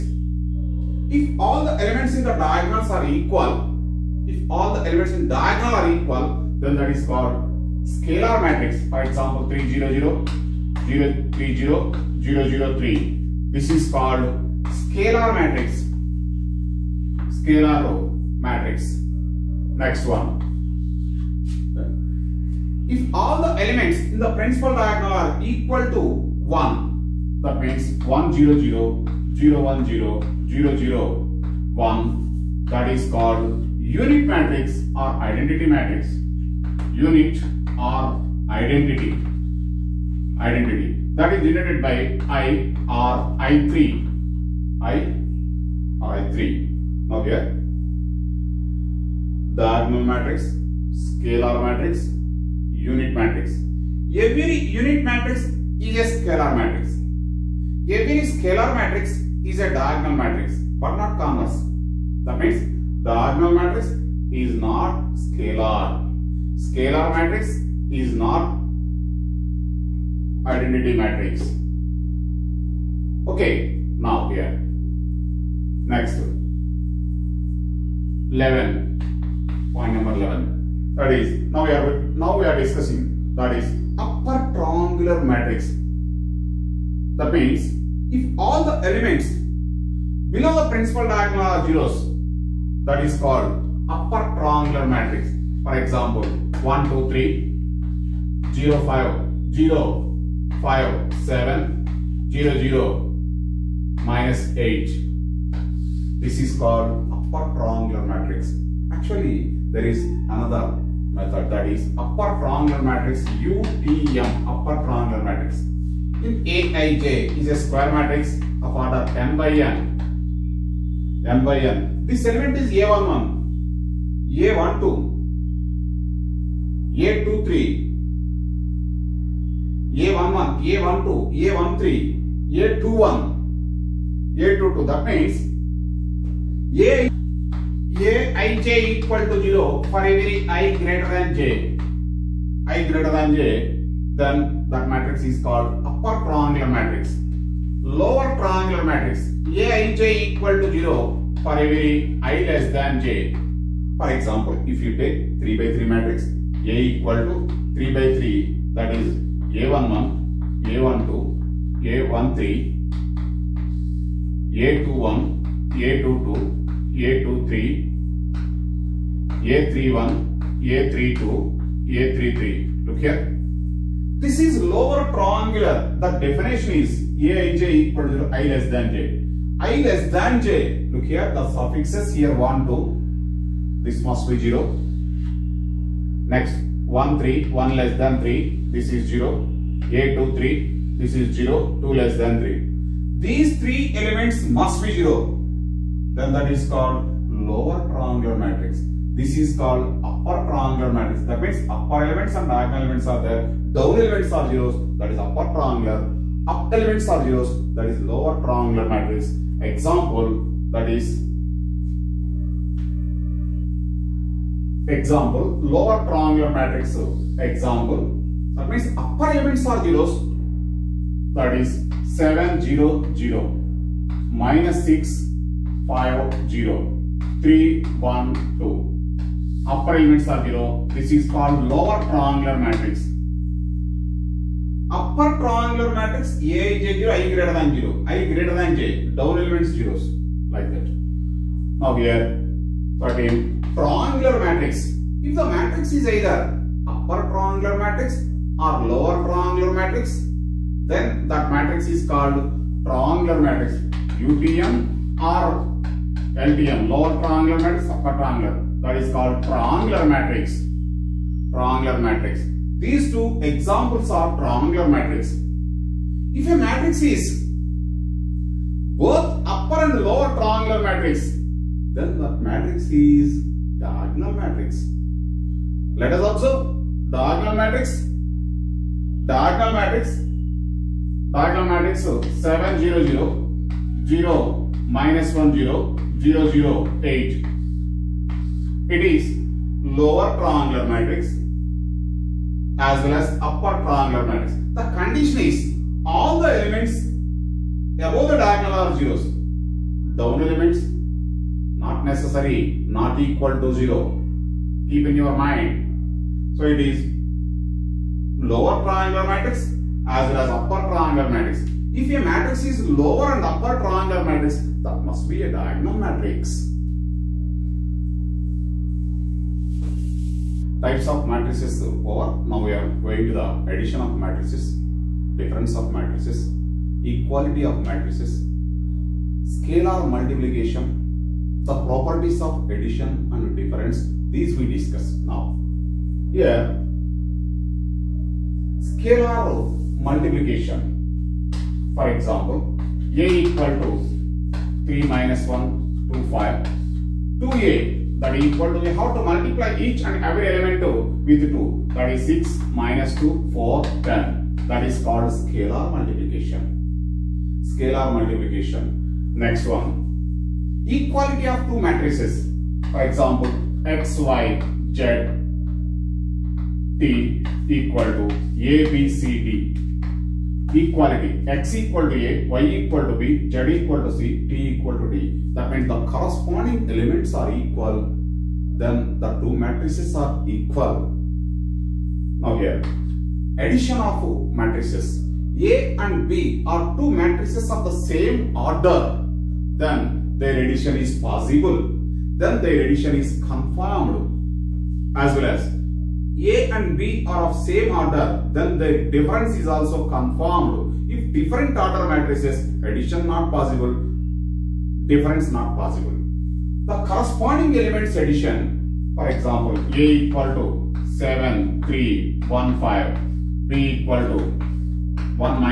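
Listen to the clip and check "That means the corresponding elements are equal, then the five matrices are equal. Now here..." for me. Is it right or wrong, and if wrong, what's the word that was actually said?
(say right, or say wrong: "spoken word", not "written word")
wrong: "two", not "five".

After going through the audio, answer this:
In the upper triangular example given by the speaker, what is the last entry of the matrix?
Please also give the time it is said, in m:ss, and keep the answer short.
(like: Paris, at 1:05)
-8, at 1:44.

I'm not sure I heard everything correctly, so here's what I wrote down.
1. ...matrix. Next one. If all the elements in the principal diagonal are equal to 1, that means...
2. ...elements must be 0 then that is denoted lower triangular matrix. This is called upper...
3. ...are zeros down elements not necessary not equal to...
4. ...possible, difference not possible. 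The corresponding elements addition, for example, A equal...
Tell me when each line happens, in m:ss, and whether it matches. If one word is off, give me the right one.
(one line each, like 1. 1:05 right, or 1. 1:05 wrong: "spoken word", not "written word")
1. 0:18 right
2. 3:13 wrong: "called", not "denoted"
3. 4:58 right
4. 6:43 right.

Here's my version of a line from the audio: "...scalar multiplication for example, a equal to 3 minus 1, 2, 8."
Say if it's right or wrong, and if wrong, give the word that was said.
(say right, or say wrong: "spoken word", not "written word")
wrong: "5", not "8".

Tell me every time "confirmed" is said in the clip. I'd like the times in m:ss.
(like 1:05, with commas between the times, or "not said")
6:33, 6:40.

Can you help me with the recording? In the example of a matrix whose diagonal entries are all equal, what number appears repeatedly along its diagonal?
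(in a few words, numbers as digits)
3.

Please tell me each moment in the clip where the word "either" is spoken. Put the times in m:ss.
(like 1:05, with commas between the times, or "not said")
4:06.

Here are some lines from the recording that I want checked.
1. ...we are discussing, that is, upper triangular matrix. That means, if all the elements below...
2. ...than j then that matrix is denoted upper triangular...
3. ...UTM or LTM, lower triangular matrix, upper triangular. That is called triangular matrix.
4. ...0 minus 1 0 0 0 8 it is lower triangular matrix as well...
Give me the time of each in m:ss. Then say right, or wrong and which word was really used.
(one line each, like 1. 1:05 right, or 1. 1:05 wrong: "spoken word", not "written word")
1. 1:22 right
2. 2:23 wrong: "called", not "denoted"
3. 4:14 right
4. 4:44 right.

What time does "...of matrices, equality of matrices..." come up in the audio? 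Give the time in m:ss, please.
5:25.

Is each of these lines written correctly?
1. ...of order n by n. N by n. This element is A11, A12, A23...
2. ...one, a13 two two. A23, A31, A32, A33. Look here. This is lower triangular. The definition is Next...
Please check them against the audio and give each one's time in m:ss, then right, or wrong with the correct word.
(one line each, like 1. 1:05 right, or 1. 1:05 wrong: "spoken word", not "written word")
1. 1:58 right
2. 2:45 wrong: "Aij", not "Next".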